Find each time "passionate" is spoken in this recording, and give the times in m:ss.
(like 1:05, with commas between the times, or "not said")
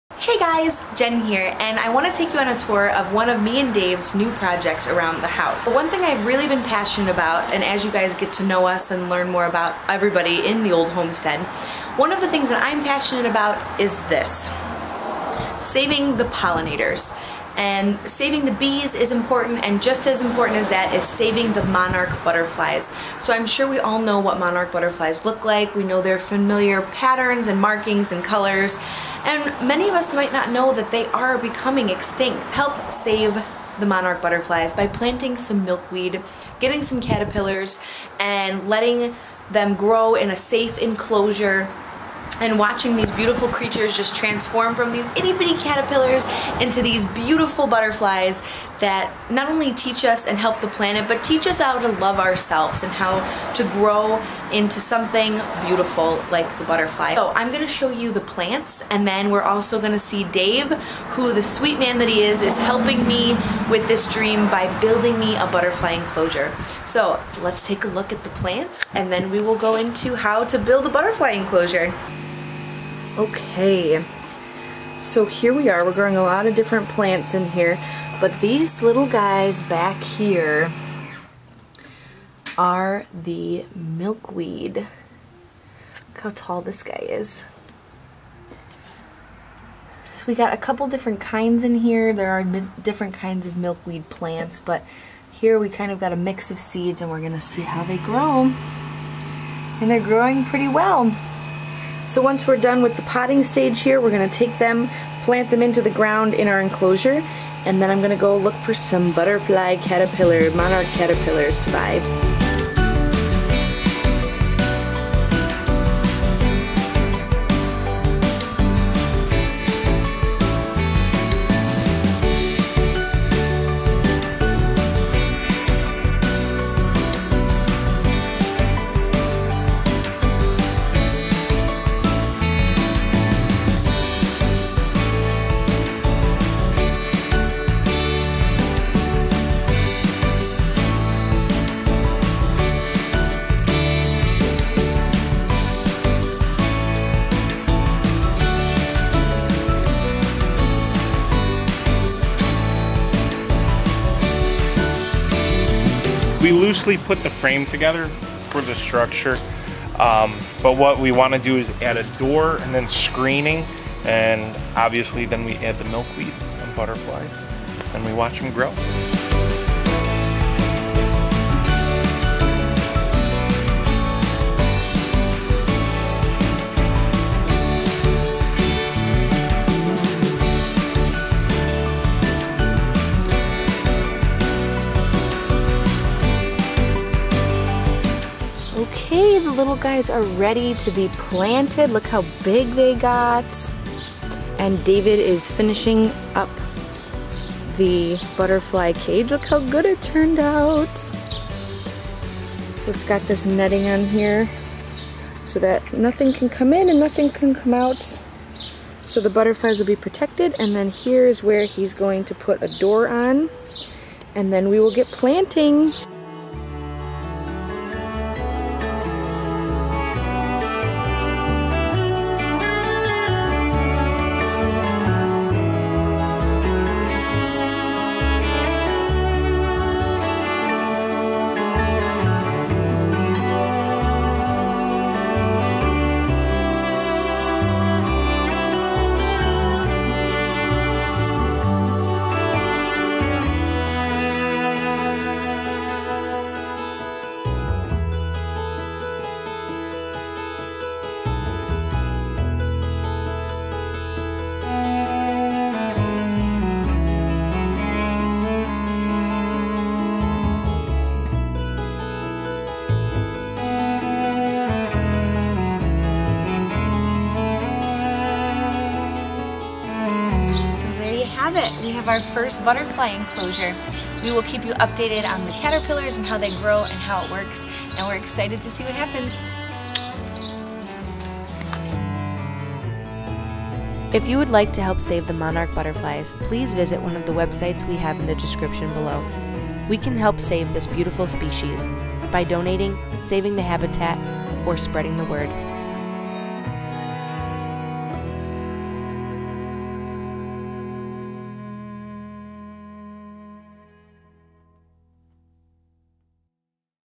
0:06, 0:12.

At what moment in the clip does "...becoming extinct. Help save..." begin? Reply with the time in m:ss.
0:31.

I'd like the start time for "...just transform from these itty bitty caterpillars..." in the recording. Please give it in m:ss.
0:43.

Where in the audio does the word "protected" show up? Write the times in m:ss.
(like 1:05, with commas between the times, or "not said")
3:29.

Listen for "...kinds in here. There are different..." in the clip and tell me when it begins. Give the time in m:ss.
1:31.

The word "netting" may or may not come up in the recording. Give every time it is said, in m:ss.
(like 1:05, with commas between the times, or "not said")
3:23.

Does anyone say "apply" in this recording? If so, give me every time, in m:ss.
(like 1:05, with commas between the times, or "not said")
not said.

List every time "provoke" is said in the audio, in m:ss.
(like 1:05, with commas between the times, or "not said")
not said.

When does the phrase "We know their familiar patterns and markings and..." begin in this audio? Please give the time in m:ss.
0:25.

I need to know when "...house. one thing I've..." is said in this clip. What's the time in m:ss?
0:05.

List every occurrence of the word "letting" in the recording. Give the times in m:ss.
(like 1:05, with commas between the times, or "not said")
0:38.